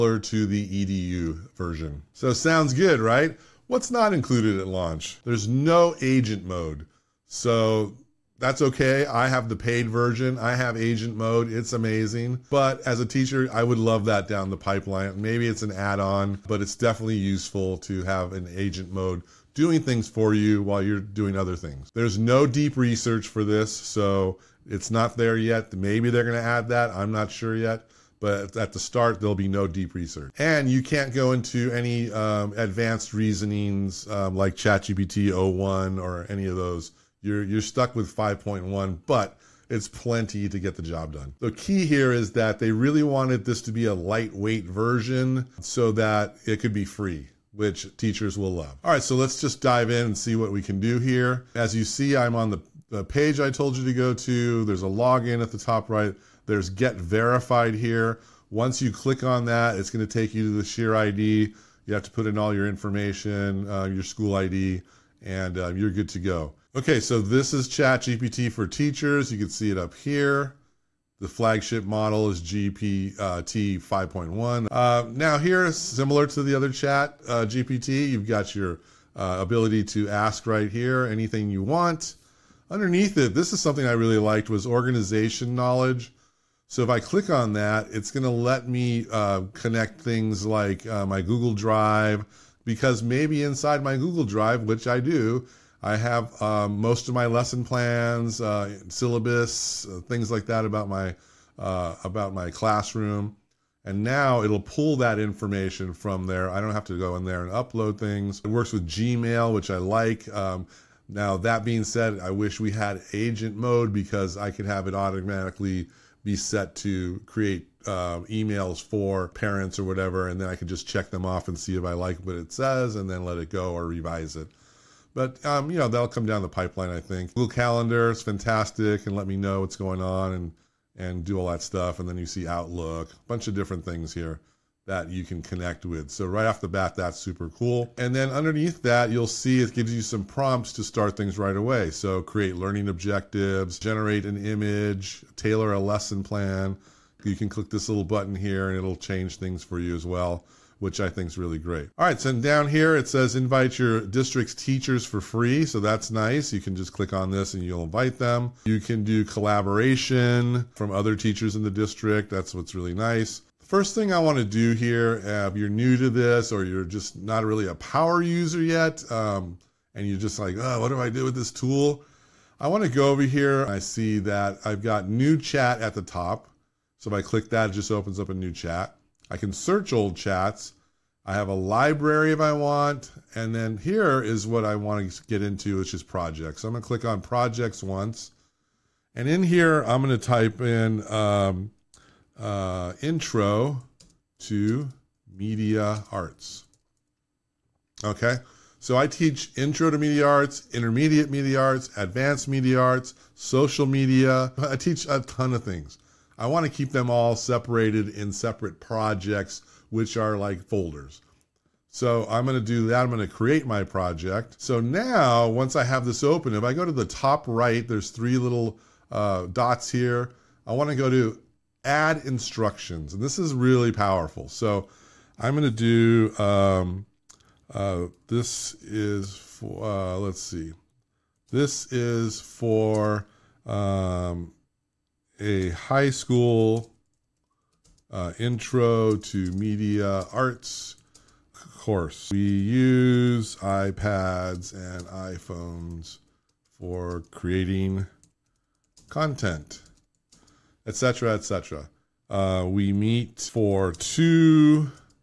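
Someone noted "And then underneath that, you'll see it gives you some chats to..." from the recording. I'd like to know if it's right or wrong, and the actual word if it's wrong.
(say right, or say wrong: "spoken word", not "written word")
wrong: "prompts", not "chats".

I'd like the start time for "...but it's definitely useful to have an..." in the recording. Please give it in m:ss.
0:16.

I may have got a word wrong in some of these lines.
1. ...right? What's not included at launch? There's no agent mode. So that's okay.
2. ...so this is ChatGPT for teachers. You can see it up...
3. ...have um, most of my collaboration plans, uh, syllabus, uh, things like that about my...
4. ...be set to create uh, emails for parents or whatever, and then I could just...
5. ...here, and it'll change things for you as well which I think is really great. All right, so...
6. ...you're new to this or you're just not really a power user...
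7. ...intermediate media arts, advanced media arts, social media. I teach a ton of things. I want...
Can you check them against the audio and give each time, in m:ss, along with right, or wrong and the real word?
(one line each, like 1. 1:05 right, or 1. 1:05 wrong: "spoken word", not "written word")
1. 0:02 right
2. 1:06 right
3. 1:35 wrong: "lesson", not "collaboration"
4. 1:56 right
5. 2:28 right
6. 2:45 right
7. 3:20 right.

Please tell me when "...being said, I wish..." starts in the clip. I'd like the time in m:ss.
1:51.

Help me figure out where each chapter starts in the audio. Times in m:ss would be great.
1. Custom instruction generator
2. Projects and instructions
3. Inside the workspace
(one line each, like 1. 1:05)
1. 3:11
2. 1:11
3. 0:11.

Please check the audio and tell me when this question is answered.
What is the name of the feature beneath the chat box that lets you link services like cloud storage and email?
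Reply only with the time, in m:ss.
1:24.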